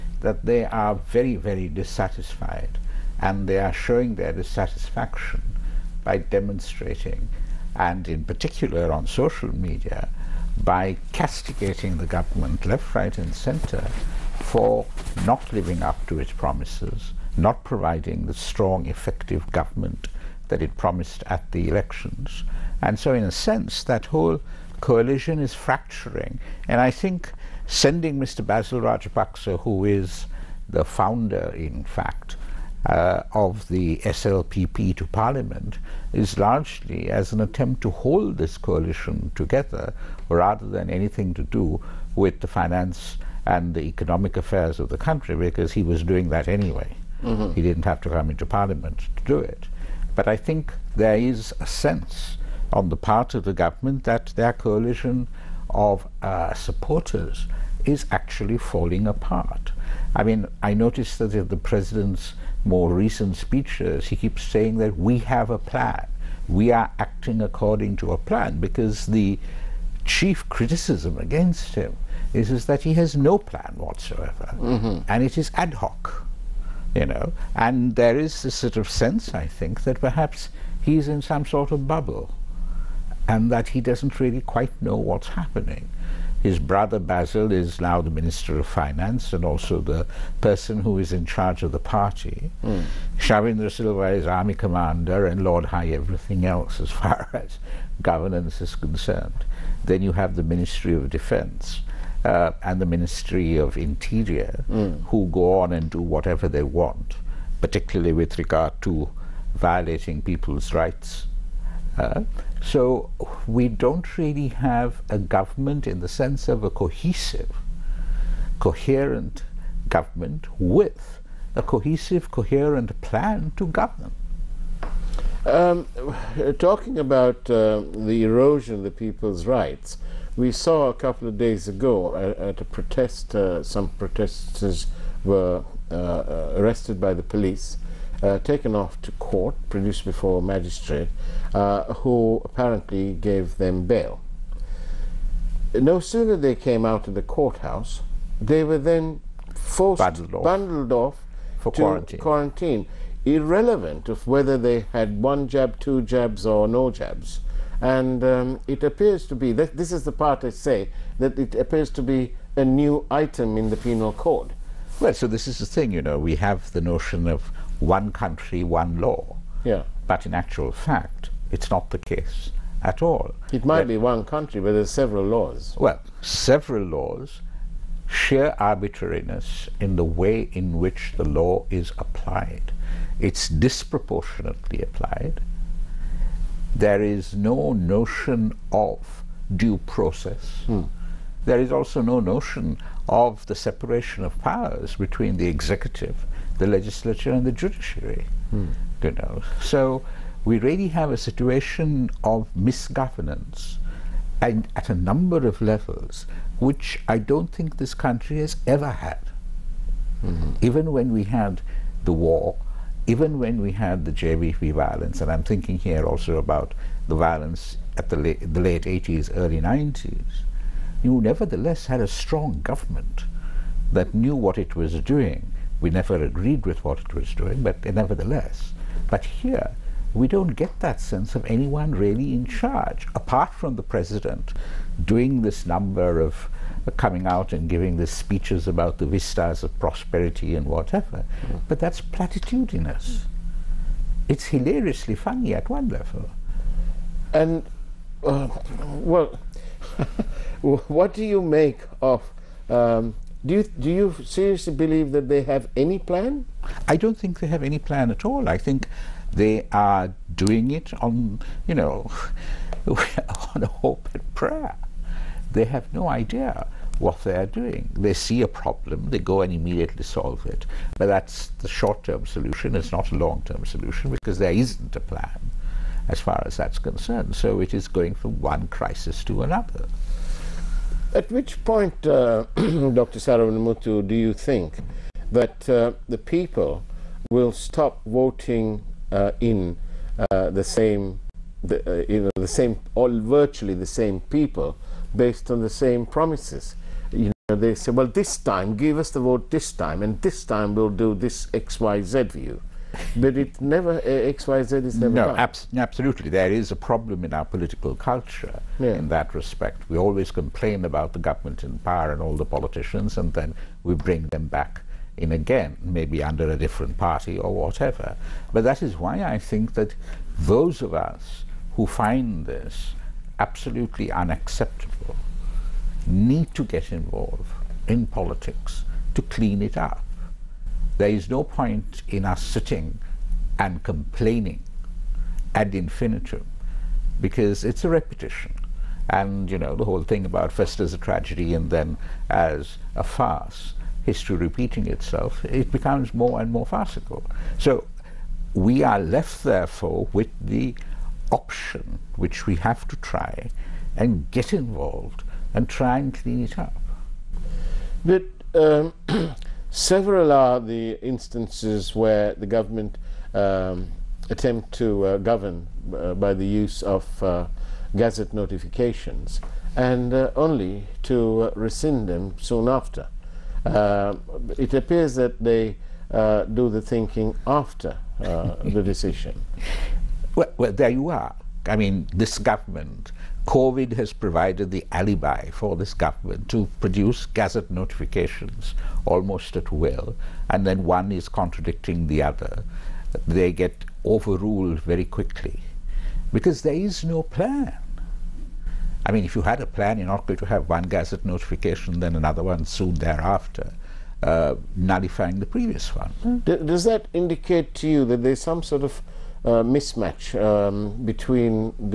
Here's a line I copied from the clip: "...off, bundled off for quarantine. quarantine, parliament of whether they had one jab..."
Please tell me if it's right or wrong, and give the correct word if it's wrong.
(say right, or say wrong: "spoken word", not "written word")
wrong: "irrelevant", not "parliament".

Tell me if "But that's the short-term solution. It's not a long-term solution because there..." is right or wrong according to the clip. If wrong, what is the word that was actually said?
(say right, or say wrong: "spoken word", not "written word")
right.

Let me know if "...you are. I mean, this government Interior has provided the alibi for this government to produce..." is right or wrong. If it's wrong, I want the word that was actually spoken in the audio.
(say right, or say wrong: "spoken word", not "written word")
wrong: "COVID", not "Interior".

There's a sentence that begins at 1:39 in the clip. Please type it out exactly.
Then you have the Ministry of Defense.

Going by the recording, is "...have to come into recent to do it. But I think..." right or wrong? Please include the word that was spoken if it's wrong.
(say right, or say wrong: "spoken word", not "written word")
wrong: "parliament", not "recent".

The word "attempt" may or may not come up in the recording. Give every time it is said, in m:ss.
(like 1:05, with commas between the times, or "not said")
0:37, 6:04.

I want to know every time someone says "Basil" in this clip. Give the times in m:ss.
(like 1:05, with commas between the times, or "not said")
0:28, 1:26.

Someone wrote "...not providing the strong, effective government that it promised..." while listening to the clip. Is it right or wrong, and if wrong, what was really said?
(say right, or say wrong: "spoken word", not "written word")
right.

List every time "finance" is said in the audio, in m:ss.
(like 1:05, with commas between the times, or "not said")
0:42, 1:28.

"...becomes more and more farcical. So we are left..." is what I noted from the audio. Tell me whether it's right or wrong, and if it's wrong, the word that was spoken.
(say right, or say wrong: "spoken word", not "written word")
right.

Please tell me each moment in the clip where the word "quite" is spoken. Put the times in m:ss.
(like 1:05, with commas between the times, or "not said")
1:24.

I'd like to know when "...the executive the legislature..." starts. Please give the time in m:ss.
3:15.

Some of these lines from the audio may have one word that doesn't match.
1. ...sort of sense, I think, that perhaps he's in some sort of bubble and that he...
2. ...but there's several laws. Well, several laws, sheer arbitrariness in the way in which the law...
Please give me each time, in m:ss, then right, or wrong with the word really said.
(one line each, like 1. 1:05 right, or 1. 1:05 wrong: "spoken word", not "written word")
1. 1:18 right
2. 2:54 right.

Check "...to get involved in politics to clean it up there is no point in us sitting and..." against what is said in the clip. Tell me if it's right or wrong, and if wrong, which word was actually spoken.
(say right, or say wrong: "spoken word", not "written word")
right.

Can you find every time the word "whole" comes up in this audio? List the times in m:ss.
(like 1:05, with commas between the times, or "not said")
0:24, 5:39.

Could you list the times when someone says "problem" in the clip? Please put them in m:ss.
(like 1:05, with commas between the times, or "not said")
4:28, 5:06.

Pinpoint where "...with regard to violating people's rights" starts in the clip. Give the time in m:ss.
1:48.